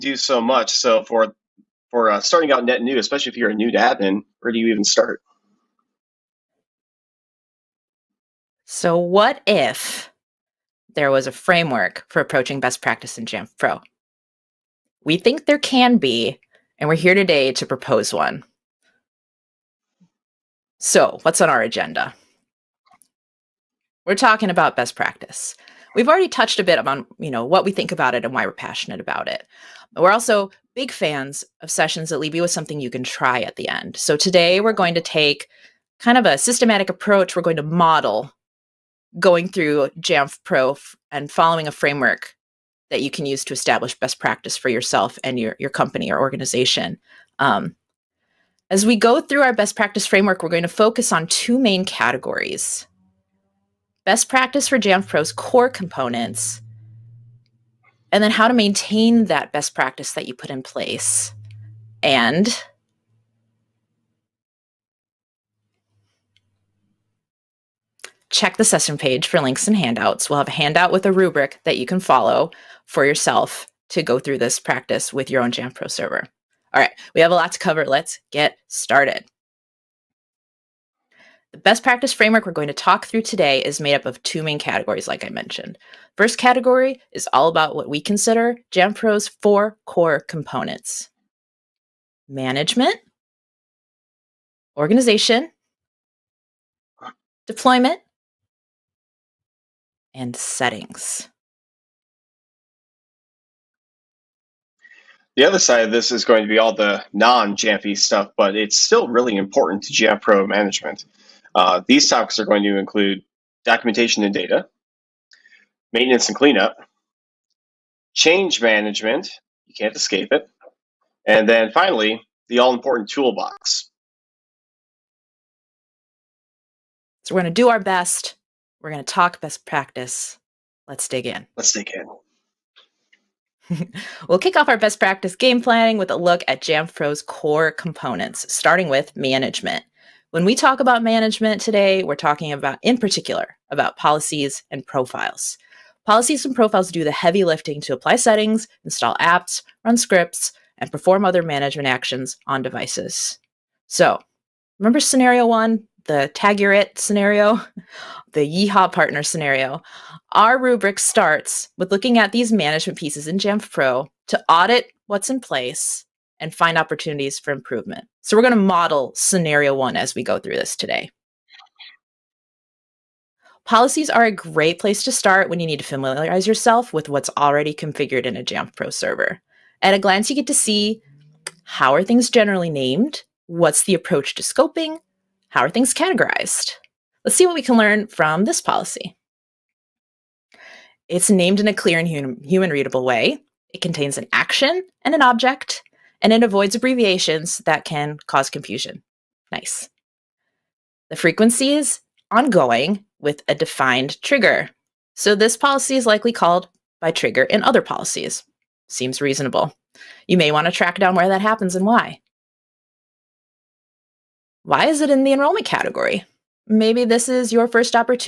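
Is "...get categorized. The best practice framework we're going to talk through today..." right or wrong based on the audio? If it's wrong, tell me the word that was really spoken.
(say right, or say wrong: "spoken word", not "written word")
wrong: "started", not "categorized".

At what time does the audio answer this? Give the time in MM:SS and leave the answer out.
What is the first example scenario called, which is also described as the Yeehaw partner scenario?
02:36.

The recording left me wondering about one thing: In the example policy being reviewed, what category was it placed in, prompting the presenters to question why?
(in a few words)
enrollment.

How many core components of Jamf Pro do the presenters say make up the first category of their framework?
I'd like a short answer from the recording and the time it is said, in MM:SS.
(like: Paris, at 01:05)
4, at 01:29.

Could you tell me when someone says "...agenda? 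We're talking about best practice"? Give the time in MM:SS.
00:21.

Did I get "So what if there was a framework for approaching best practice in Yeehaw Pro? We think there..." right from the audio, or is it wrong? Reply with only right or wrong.
wrong.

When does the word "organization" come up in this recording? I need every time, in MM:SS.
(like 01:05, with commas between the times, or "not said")
00:46, 01:34.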